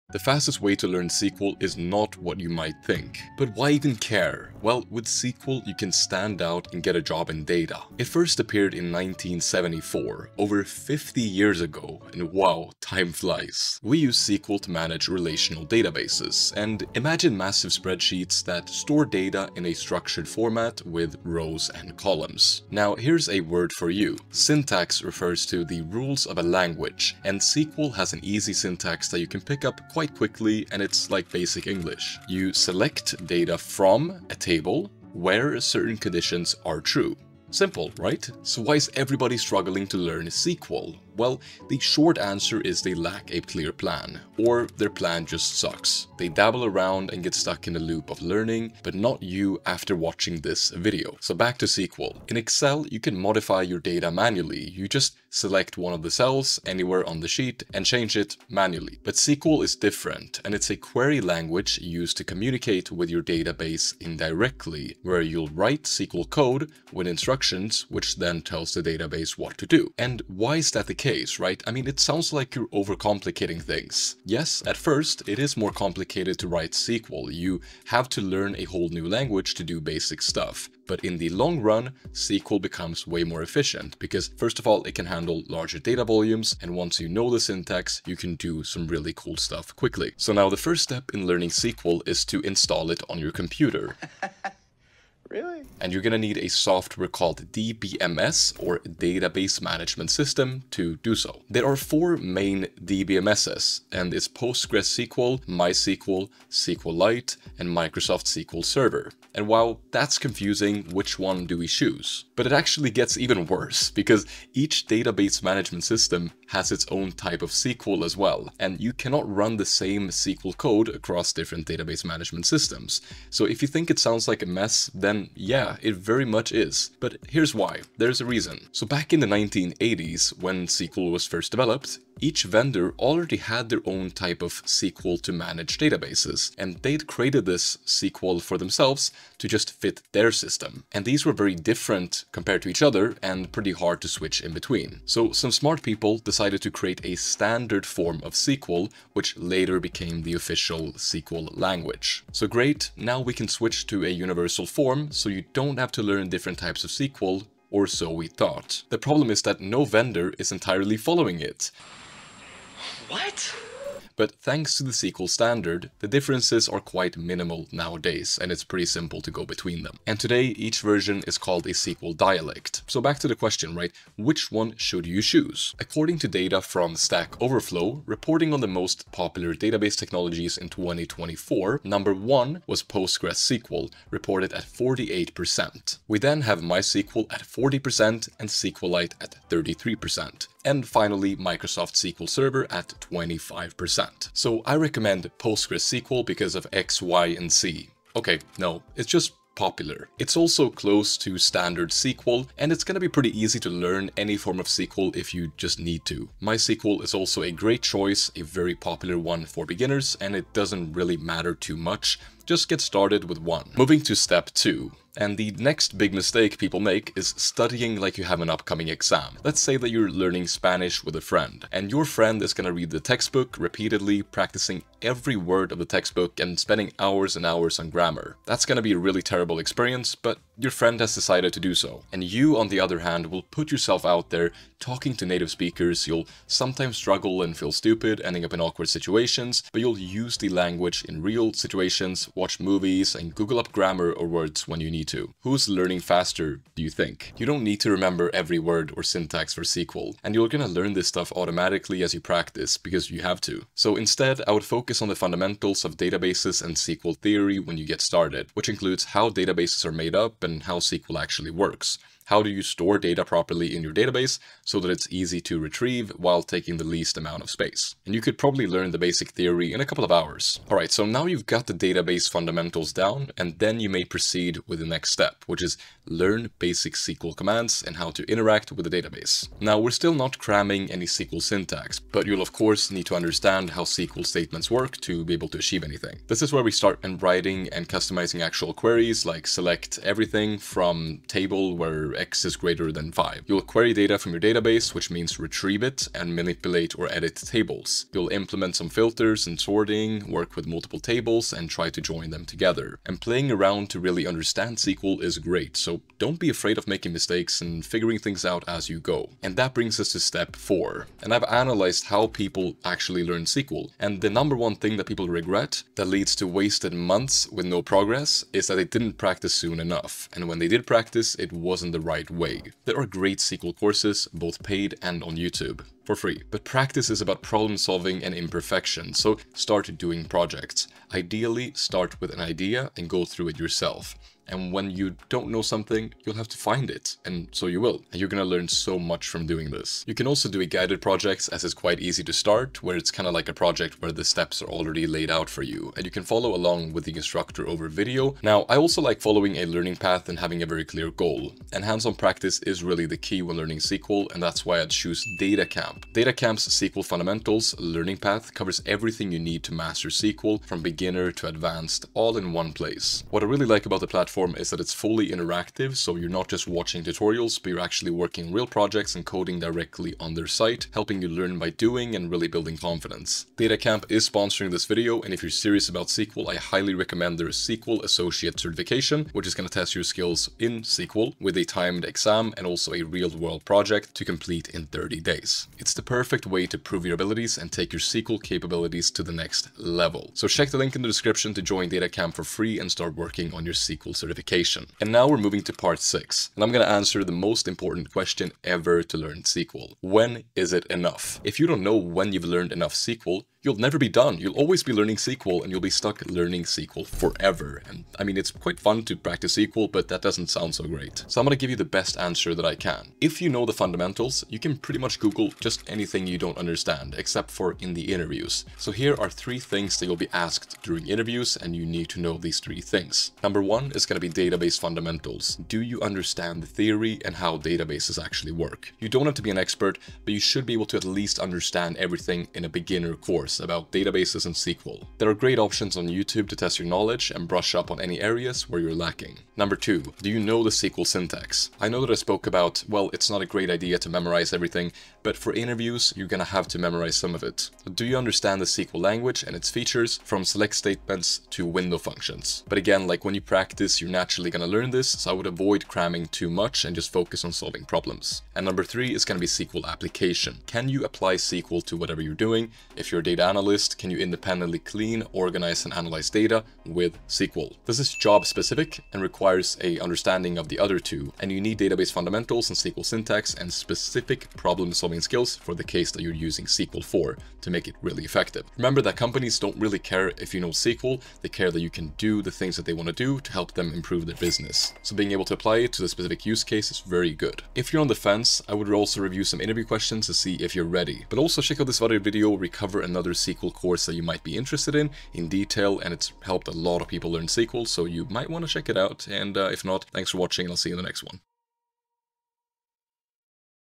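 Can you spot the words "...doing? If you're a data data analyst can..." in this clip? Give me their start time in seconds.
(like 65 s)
462 s.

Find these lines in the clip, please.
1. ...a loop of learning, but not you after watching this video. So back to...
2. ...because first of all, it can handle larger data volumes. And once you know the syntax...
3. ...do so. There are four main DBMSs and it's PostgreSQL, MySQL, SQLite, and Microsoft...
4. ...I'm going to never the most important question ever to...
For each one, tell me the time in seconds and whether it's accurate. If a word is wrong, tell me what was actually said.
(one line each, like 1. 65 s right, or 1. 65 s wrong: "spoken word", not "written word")
1. 47 s right
2. 83 s right
3. 100 s right
4. 396 s wrong: "answer", not "never".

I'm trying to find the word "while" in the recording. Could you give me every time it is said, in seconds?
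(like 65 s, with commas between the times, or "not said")
109 s, 266 s.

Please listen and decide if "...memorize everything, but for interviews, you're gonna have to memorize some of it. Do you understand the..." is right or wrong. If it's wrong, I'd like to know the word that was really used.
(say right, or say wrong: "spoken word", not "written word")
right.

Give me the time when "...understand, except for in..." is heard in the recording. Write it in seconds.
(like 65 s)
416 s.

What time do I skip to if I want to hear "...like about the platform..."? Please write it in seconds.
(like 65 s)
363 s.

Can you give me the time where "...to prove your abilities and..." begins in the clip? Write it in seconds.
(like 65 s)
386 s.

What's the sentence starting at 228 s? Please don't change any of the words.
That's gonna be a really terrible experience, but your friend has decided to do so.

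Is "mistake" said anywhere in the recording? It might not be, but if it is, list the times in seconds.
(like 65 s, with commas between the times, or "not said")
216 s, 307 s.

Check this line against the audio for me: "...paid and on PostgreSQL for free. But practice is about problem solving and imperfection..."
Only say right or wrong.
wrong.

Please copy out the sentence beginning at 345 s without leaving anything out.
And you can follow along with the instructor over video.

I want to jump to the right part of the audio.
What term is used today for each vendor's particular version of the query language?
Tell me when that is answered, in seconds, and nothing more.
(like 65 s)
171 s.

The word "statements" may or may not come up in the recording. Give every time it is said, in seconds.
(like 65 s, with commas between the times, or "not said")
284 s, 450 s.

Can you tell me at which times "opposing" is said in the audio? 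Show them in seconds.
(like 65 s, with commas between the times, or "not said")
not said.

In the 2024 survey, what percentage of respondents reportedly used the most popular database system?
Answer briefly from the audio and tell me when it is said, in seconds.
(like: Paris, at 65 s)
48%, at 184 s.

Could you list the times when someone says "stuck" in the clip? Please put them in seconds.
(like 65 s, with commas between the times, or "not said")
47 s, 405 s.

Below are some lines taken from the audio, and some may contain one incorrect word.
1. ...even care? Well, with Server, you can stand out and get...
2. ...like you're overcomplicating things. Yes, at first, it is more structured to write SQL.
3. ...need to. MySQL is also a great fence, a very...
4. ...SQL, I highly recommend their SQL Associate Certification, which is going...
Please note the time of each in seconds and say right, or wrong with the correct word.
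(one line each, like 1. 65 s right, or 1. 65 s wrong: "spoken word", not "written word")
1. 3 s wrong: "SQL", not "Server"
2. 72 s wrong: "complicated", not "structured"
3. 205 s wrong: "choice", not "fence"
4. 376 s right.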